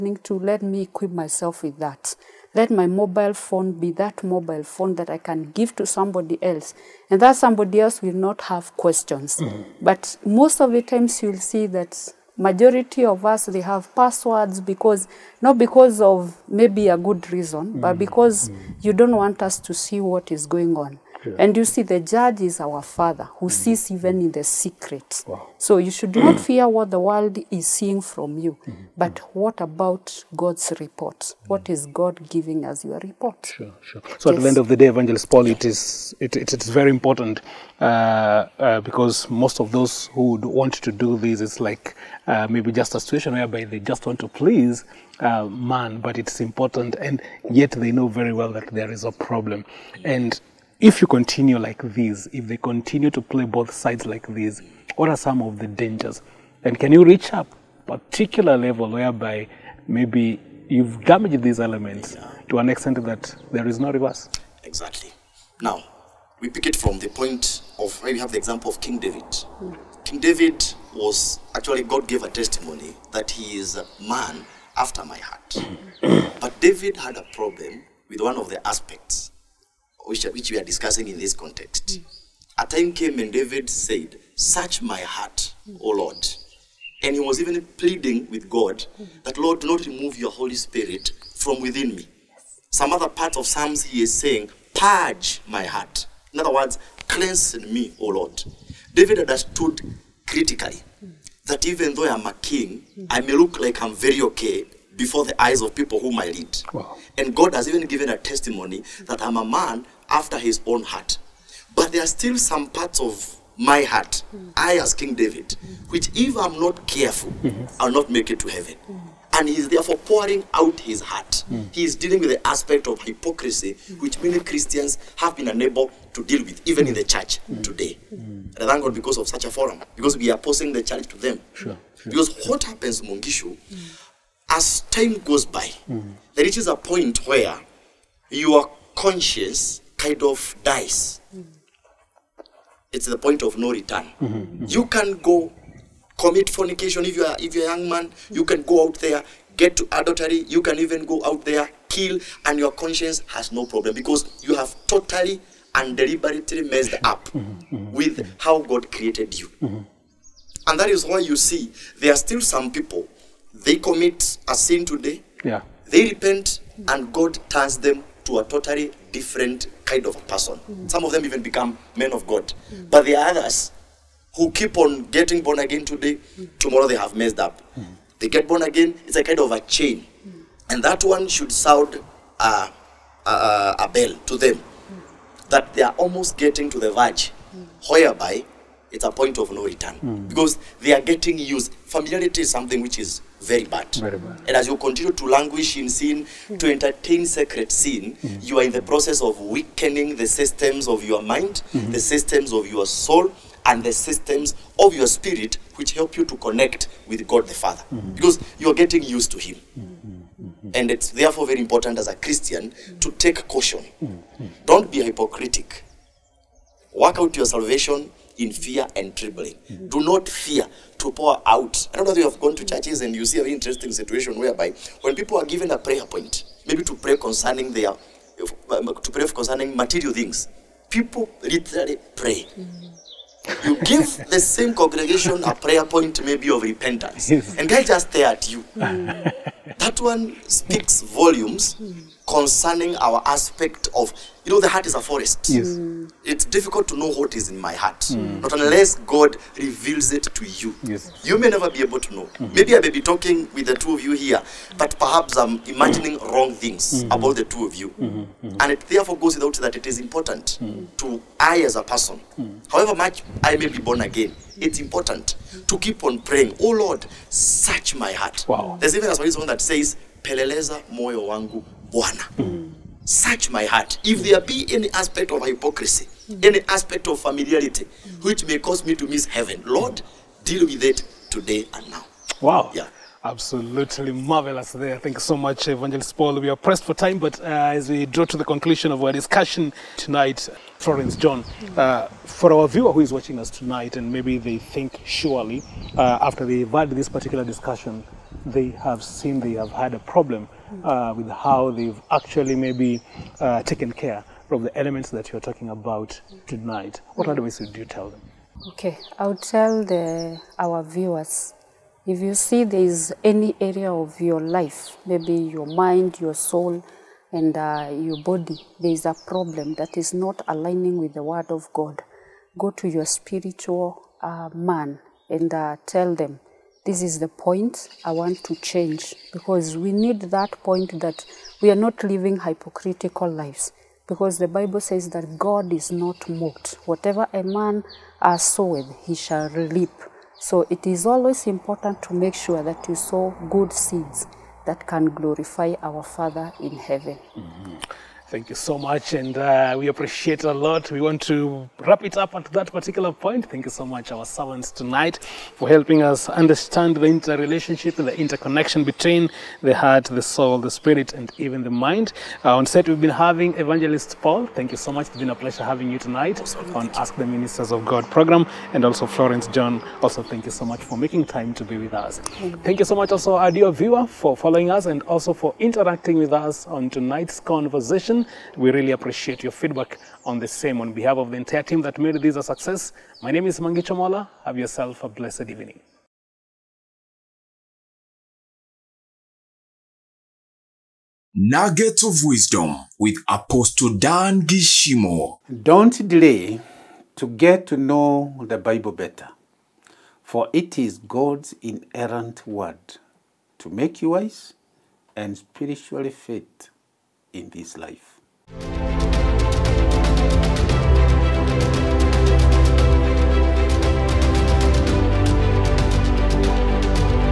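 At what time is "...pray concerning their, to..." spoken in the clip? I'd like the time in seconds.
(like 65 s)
226 s.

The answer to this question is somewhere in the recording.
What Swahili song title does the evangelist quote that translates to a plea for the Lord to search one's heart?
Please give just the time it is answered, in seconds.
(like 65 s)
270 s.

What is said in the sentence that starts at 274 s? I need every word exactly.
If there be any aspect of hypocrisy, mm.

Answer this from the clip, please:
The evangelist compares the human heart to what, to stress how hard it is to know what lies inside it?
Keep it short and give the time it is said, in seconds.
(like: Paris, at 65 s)
A forest, at 244 s.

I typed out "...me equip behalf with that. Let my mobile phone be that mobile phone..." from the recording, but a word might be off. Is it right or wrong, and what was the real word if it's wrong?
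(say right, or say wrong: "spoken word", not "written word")
wrong: "myself", not "behalf".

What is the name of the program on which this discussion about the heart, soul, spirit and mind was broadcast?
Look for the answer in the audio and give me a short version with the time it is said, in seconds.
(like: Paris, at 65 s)
Ask the Ministers of God, at 366 s.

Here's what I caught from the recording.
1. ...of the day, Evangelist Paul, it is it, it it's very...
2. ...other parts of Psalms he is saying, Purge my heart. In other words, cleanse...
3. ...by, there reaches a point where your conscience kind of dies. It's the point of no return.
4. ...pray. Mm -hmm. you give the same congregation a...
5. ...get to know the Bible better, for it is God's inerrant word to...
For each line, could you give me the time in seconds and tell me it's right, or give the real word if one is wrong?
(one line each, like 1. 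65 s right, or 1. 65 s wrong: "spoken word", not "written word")
1. 34 s right
2. 92 s right
3. 135 s right
4. 232 s right
5. 397 s right.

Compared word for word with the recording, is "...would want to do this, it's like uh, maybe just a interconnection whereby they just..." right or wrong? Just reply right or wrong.
wrong.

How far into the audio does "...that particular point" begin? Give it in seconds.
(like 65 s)
352 s.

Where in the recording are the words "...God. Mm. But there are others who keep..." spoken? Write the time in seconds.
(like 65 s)
172 s.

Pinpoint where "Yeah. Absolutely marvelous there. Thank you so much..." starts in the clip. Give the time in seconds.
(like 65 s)
282 s.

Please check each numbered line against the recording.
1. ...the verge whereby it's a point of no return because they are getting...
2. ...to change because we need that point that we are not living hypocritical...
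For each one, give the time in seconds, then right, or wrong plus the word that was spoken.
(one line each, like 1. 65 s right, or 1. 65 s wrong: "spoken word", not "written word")
1. 186 s right
2. 328 s right.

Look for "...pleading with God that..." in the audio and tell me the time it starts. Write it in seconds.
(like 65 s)
87 s.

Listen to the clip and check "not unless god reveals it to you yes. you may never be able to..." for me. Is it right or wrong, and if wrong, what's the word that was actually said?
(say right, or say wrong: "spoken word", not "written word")
right.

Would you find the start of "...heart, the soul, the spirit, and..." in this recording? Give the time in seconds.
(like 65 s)
359 s.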